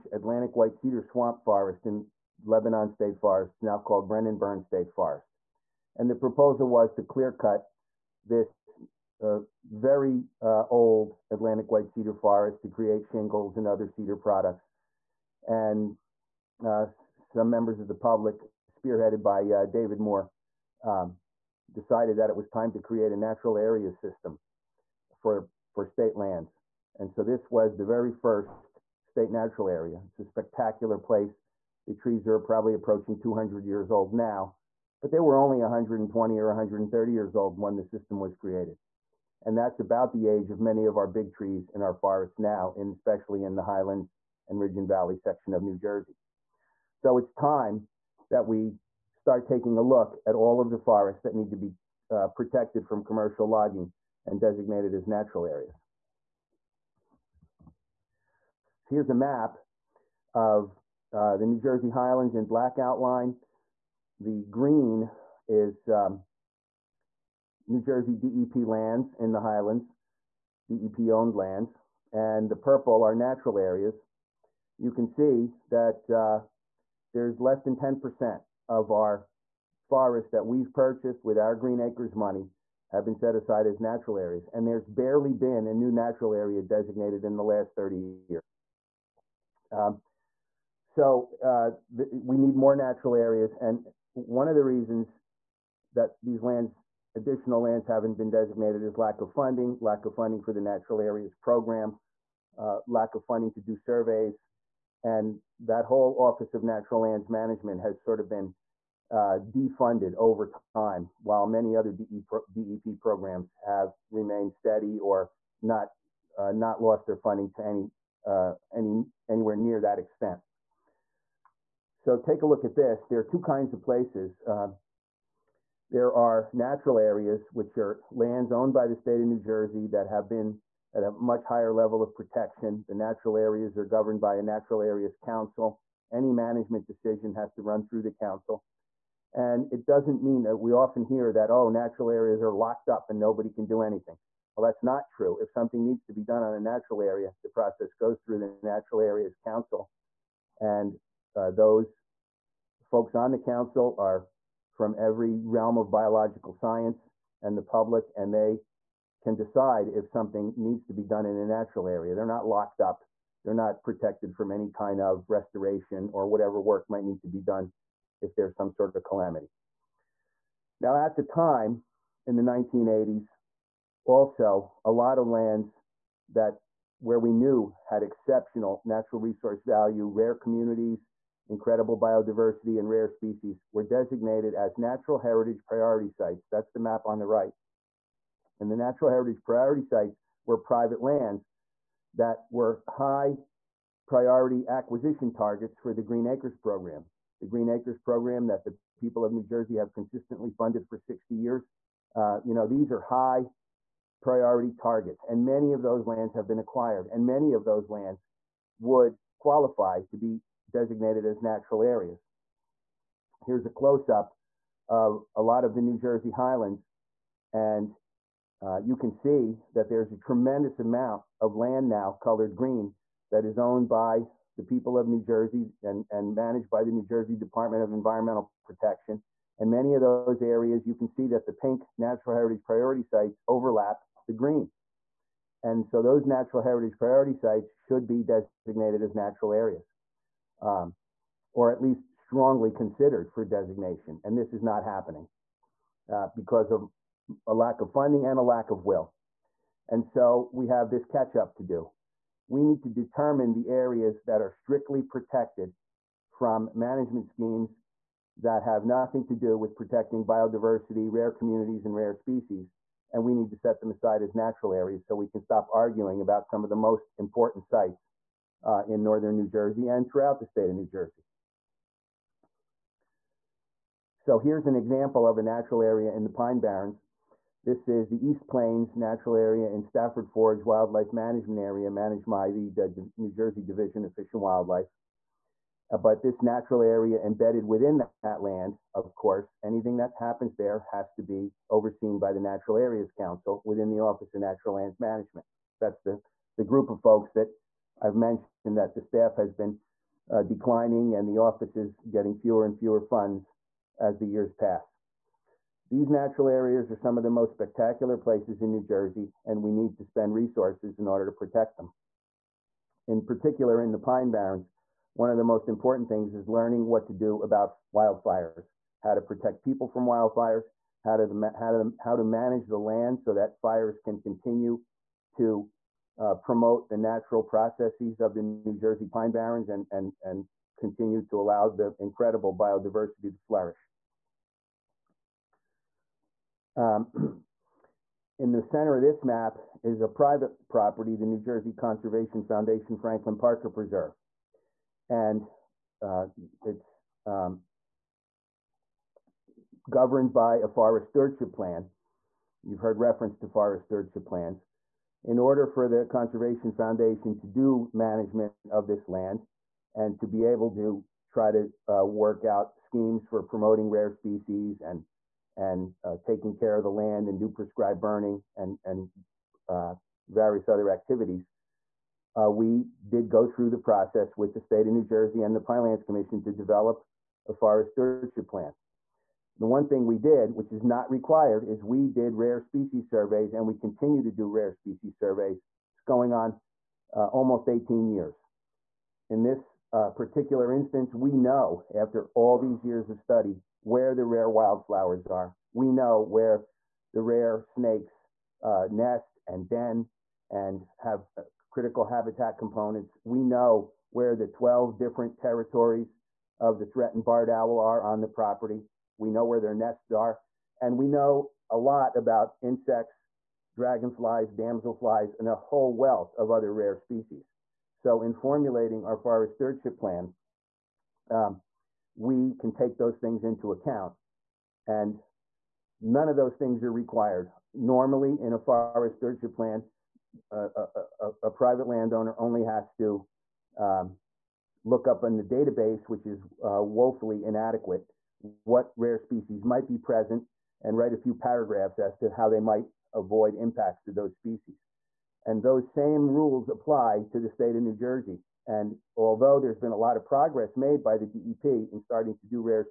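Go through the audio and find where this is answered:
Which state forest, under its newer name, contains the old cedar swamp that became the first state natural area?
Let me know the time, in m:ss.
0:04.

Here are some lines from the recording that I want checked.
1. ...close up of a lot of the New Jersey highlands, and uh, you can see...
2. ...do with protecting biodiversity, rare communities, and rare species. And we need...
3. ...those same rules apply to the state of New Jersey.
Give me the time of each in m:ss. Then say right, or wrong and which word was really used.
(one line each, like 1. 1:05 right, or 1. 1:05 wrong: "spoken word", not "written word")
1. 3:33 right
2. 4:19 right
3. 7:25 right.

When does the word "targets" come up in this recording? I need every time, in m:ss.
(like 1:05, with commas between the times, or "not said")
3:15, 3:24.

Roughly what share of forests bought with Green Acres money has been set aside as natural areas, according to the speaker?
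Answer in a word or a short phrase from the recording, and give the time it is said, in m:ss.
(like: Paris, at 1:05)
less than 10%, at 1:17.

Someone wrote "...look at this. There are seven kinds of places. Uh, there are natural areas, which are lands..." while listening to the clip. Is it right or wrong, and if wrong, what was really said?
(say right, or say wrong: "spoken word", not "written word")
wrong: "two", not "seven".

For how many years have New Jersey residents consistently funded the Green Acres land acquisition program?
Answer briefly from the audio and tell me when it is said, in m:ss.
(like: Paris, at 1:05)
60 years, at 3:20.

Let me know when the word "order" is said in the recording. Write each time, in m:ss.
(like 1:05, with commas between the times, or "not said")
5:11, 5:55.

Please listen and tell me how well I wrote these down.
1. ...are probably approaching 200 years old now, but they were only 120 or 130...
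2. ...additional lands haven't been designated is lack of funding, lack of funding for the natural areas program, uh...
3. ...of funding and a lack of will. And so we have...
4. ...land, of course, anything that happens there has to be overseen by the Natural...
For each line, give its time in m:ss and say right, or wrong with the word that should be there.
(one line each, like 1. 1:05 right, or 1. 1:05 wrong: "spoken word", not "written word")
1. 0:32 right
2. 1:37 right
3. 4:07 right
4. 4:48 right.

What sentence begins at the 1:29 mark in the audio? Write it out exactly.
Um, so uh, we need more natural areas.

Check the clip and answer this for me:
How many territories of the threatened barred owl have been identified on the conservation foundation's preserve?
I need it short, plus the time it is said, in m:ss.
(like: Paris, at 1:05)
12, at 6:44.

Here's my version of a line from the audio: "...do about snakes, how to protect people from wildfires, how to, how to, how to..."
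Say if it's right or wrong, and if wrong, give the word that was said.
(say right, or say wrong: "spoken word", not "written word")
wrong: "wildfires", not "snakes".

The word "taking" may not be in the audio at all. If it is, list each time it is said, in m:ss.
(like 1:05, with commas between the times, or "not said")
0:49, 6:06.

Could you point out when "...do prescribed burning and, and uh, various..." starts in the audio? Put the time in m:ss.
6:07.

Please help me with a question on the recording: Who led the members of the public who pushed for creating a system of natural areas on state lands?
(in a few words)
David Moore.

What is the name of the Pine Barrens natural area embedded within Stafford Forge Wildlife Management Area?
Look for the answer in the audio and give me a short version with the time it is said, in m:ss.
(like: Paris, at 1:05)
East Plains Natural Area, at 4:38.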